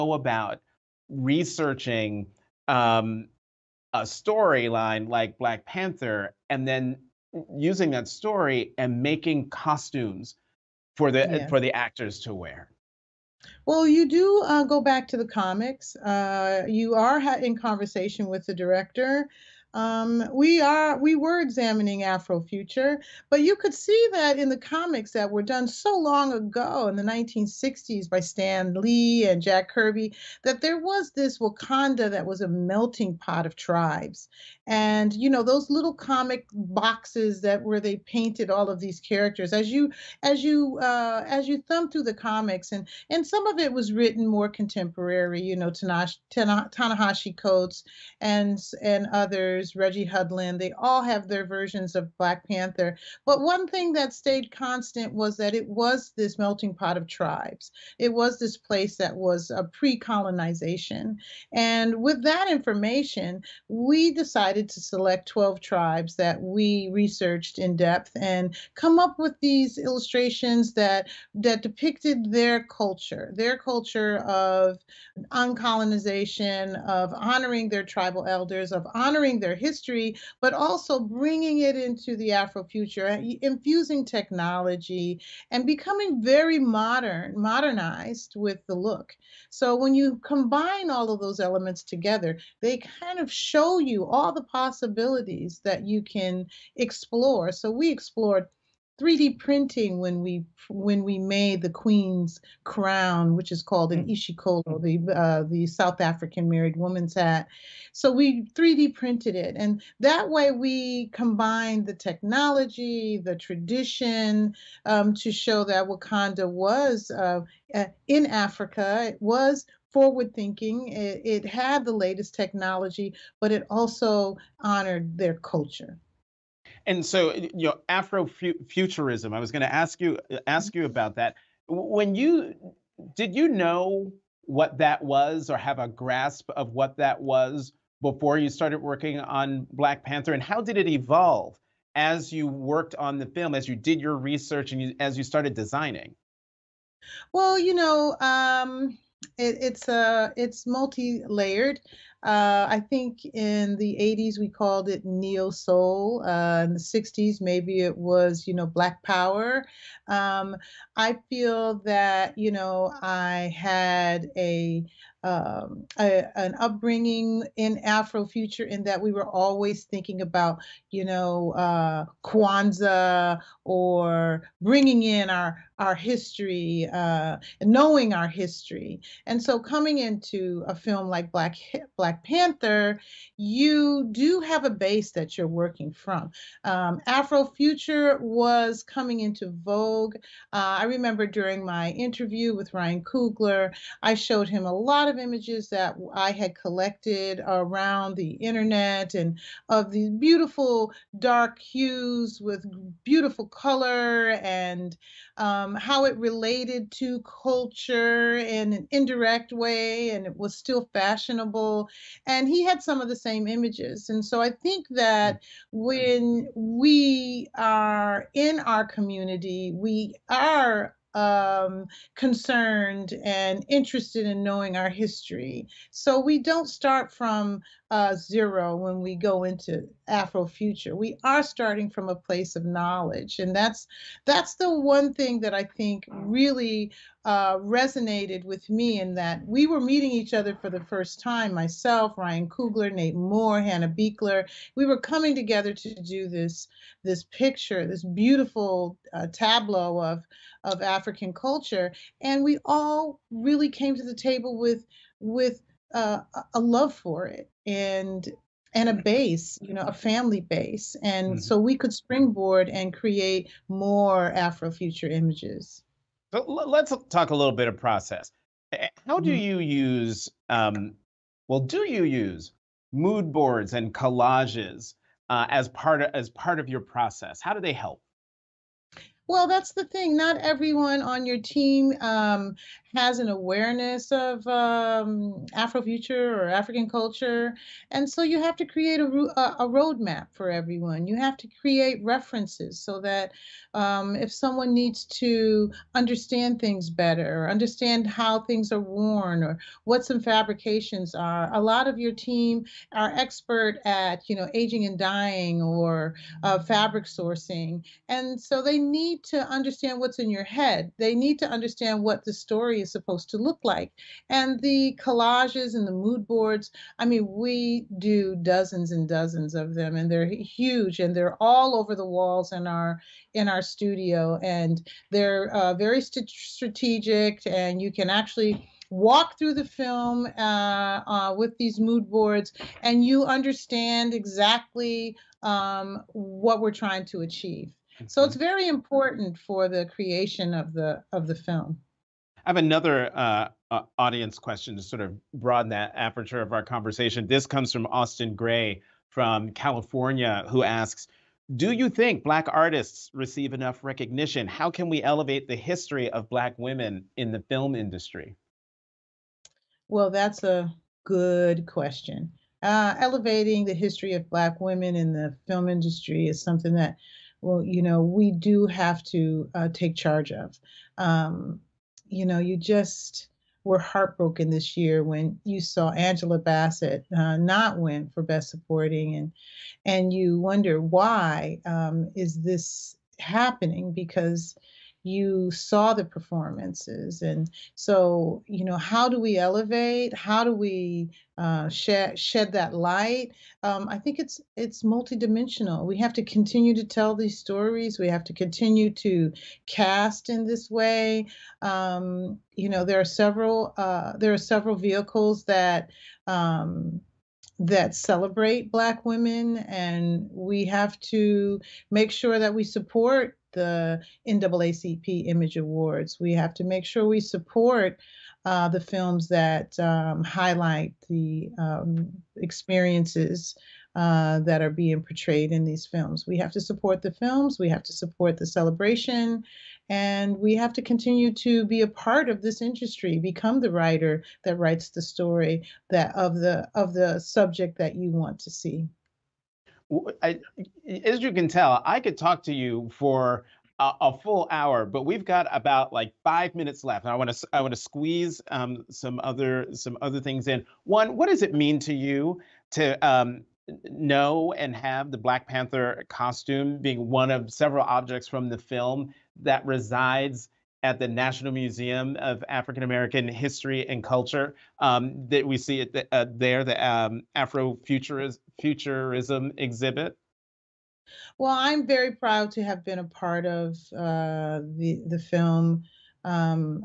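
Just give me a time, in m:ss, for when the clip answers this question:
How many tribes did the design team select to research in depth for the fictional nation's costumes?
1:05.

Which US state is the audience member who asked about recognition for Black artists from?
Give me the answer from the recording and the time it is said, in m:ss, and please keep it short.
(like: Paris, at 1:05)
California, at 5:49.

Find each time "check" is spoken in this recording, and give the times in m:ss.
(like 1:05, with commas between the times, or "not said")
not said.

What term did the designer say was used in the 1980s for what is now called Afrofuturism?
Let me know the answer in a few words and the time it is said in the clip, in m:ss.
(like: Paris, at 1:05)
neo soul, at 2:35.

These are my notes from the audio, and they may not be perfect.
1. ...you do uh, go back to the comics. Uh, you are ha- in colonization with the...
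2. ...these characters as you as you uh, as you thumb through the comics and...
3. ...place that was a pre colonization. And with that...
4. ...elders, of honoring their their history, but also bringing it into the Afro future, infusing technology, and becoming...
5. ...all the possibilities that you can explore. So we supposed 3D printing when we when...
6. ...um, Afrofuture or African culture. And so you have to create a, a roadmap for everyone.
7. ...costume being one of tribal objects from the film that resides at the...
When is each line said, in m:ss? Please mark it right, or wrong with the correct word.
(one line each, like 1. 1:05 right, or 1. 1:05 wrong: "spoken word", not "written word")
1. 0:13 wrong: "conversation", not "colonization"
2. 0:38 right
3. 0:58 right
4. 1:18 right
5. 1:34 wrong: "explored", not "supposed"
6. 4:44 right
7. 7:36 wrong: "several", not "tribal".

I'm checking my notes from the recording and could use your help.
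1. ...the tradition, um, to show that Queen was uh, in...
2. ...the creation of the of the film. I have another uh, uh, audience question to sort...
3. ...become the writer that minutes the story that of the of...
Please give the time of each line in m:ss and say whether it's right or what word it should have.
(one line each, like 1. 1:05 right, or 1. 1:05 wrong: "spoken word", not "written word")
1. 1:53 wrong: "Wakanda", not "Queen"
2. 5:39 right
3. 7:13 wrong: "writes", not "minutes".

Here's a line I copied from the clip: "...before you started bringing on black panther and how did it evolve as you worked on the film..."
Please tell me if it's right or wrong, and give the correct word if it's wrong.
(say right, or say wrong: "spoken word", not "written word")
wrong: "working", not "bringing".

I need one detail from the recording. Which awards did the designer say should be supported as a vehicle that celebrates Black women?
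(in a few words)
NAACP Image Awards.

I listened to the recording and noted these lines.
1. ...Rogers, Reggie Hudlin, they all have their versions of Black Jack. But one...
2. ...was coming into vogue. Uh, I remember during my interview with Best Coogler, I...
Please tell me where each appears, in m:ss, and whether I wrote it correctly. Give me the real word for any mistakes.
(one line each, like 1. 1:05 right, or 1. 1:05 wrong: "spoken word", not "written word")
1. 0:49 wrong: "Panther", not "Jack"
2. 3:08 wrong: "Ryan", not "Best".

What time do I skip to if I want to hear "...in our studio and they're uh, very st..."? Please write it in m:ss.
5:23.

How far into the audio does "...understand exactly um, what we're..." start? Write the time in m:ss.
5:33.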